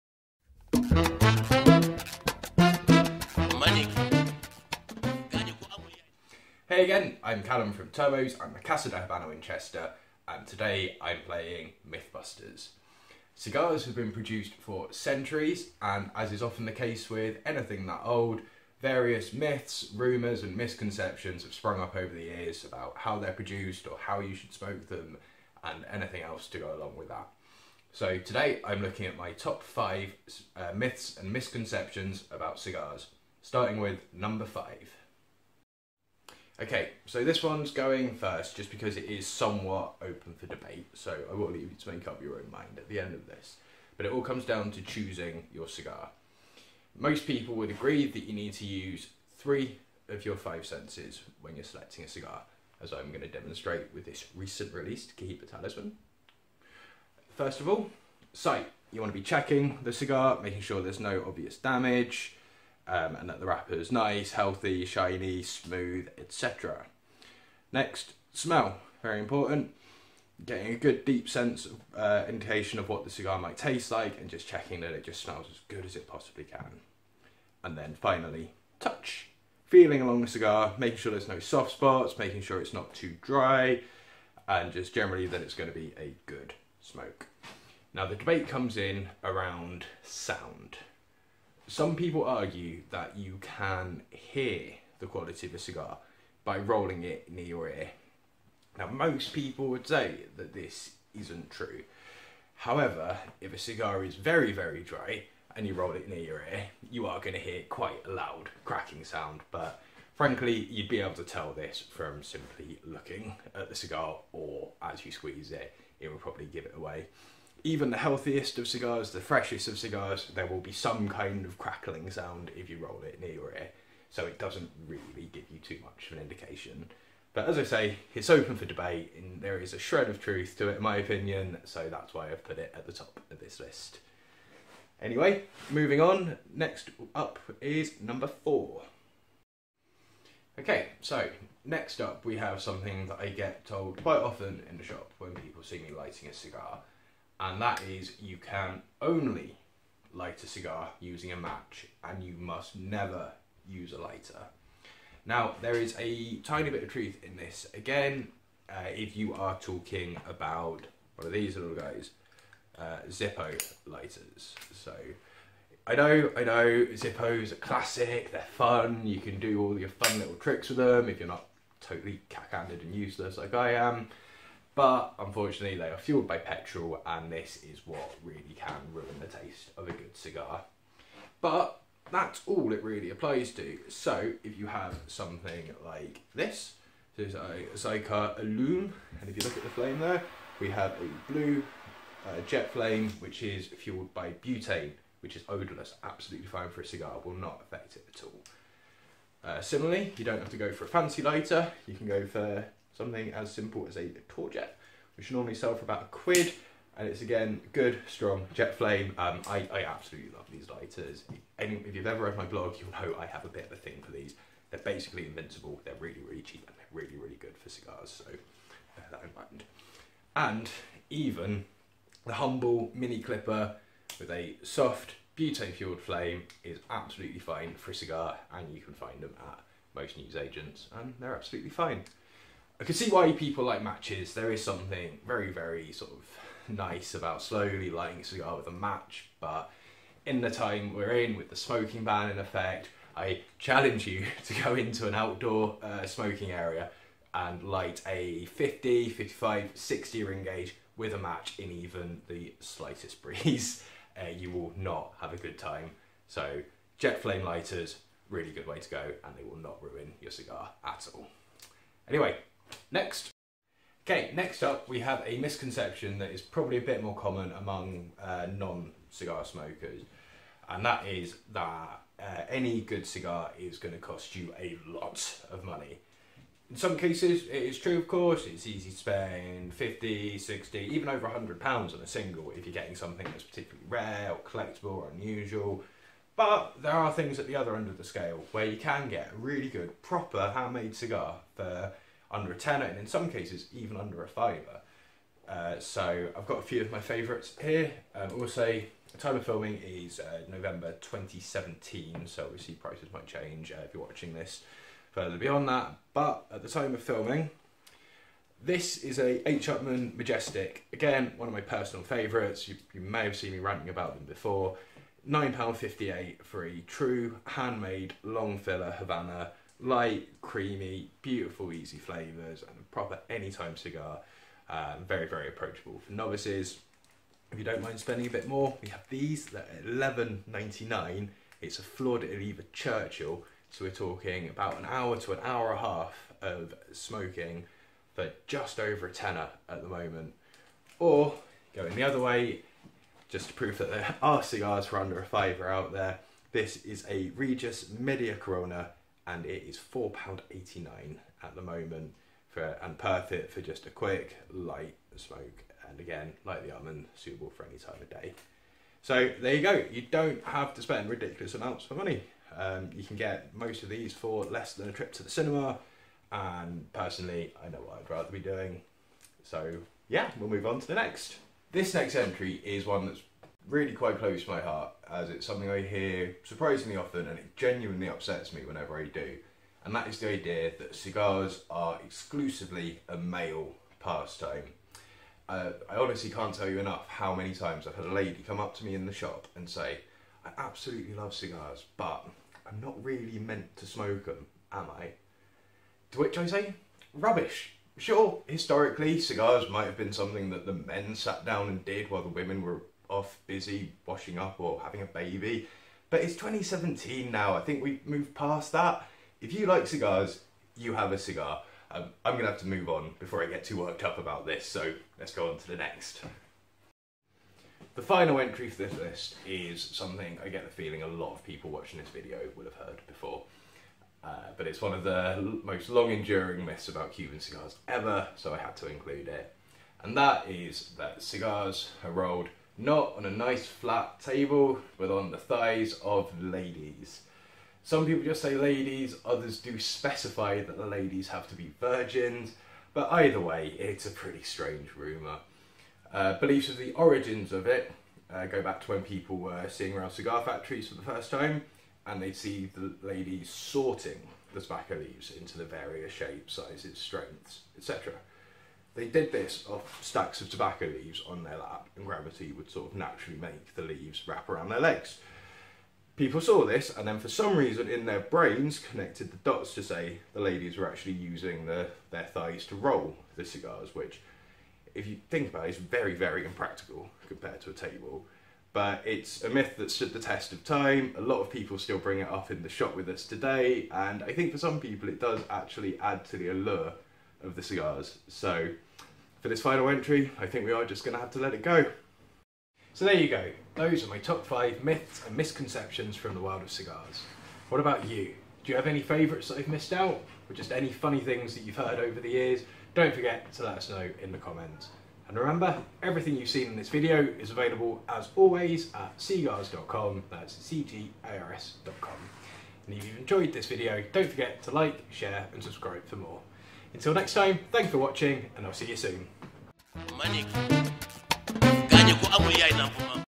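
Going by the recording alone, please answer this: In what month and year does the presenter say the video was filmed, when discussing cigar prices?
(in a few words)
November 2017.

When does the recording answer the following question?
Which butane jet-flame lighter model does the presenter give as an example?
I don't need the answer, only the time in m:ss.
3:07.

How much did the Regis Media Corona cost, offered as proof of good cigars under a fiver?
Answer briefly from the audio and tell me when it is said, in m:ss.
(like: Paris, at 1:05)
£4.89, at 5:49.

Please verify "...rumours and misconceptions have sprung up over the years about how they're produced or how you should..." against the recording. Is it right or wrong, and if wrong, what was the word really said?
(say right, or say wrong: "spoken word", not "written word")
right.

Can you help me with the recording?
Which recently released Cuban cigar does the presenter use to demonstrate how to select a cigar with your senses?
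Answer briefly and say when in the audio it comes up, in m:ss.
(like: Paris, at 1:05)
Cohiba Talisman, at 0:55.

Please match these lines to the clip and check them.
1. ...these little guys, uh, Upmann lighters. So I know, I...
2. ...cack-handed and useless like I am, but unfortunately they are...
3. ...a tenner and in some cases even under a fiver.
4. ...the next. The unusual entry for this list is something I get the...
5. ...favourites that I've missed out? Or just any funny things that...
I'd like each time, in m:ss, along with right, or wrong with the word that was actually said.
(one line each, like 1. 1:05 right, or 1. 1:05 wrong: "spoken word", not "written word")
1. 2:41 wrong: "Zippo", not "Upmann"
2. 2:52 right
3. 4:52 right
4. 6:55 wrong: "final", not "unusual"
5. 8:19 right.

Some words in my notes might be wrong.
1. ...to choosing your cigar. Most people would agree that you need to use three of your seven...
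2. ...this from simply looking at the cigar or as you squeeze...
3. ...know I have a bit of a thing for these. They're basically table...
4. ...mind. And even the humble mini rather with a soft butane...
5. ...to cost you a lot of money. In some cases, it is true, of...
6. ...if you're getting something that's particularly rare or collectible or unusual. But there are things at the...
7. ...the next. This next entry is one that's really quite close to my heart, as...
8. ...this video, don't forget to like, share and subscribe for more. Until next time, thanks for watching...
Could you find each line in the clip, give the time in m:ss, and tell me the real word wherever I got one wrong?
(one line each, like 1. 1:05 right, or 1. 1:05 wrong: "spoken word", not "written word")
1. 0:44 wrong: "five", not "seven"
2. 1:51 right
3. 3:32 wrong: "invincible", not "table"
4. 3:39 wrong: "clipper", not "rather"
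5. 4:33 right
6. 4:42 right
7. 6:10 right
8. 8:33 right.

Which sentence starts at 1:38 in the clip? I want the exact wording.
Now most people would say that this isn't true.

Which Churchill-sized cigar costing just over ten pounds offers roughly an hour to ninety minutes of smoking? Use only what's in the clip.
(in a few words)
Flor de Oliva Churchill.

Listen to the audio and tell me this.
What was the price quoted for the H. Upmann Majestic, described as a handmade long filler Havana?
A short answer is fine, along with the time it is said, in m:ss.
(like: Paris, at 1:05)
£9.58, at 5:15.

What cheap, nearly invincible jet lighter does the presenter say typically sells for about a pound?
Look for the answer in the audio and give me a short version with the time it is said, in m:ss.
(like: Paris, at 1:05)
Torjet, at 3:24.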